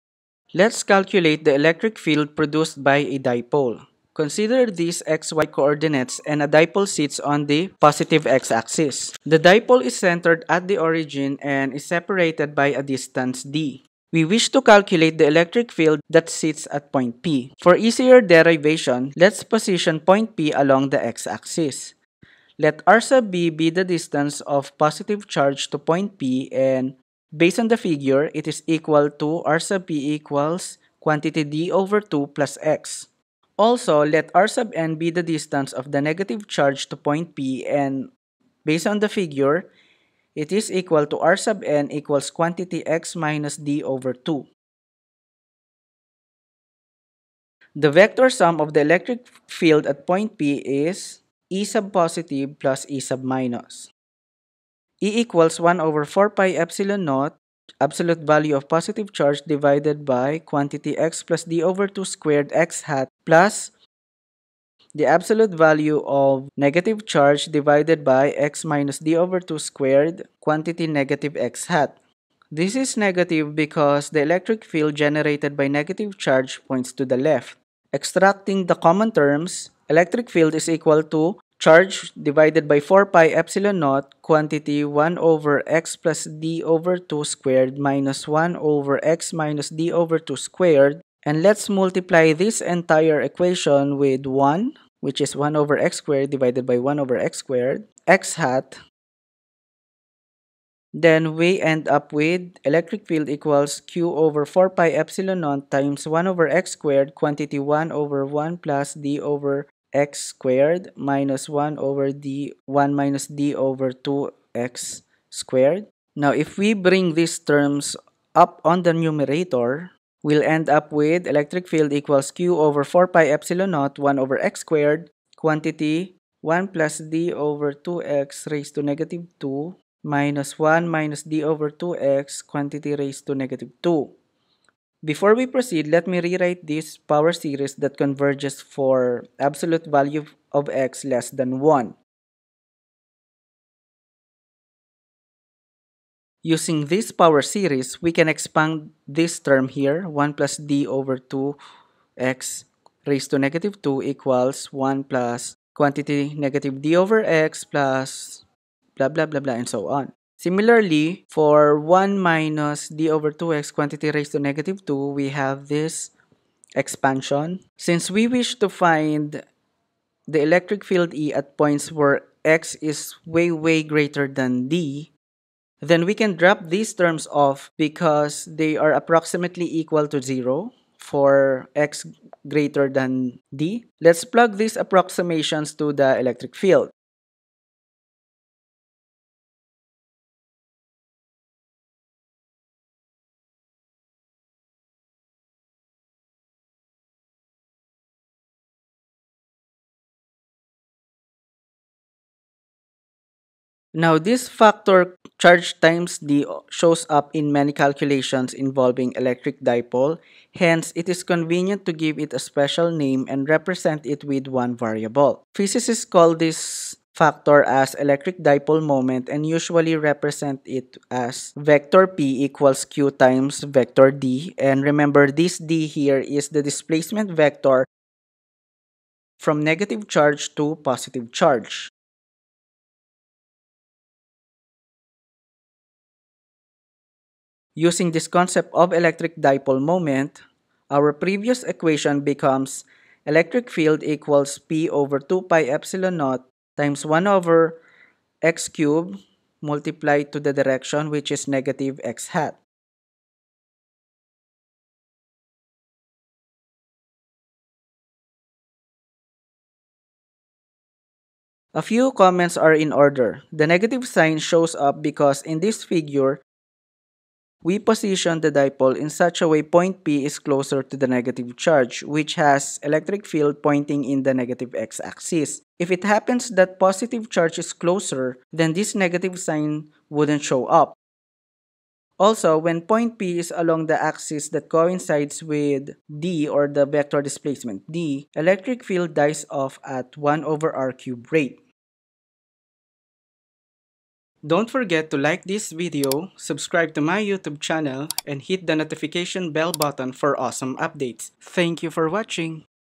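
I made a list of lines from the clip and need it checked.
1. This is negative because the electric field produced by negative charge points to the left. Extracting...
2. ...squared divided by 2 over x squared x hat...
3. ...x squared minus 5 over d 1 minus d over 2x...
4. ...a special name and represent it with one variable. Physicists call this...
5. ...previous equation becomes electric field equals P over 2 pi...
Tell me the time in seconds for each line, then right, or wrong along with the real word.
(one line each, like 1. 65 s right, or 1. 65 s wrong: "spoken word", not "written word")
1. 72 s wrong: "generated", not "produced"
2. 96 s wrong: "1", not "2"
3. 109 s wrong: "1", not "5"
4. 212 s right
5. 241 s right.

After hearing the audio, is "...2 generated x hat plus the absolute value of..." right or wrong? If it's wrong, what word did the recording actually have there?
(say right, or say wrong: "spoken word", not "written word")
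wrong: "squared", not "generated".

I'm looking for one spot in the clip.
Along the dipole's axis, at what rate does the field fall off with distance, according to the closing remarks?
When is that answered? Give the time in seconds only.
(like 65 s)
290 s.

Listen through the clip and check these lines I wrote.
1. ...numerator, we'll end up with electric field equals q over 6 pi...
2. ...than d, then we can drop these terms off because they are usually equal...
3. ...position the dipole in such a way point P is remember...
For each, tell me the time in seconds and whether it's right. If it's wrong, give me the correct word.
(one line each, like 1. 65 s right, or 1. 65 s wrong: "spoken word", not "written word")
1. 118 s wrong: "4", not "6"
2. 174 s wrong: "approximately", not "usually"
3. 267 s wrong: "closer", not "remember".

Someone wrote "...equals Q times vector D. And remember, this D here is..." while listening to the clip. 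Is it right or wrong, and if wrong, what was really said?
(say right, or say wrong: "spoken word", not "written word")
right.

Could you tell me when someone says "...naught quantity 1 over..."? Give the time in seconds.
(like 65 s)
83 s.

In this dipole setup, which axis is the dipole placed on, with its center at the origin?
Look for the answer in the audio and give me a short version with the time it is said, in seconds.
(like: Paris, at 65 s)
positive x-axis, at 7 s.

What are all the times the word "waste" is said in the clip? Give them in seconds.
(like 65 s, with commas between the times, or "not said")
not said.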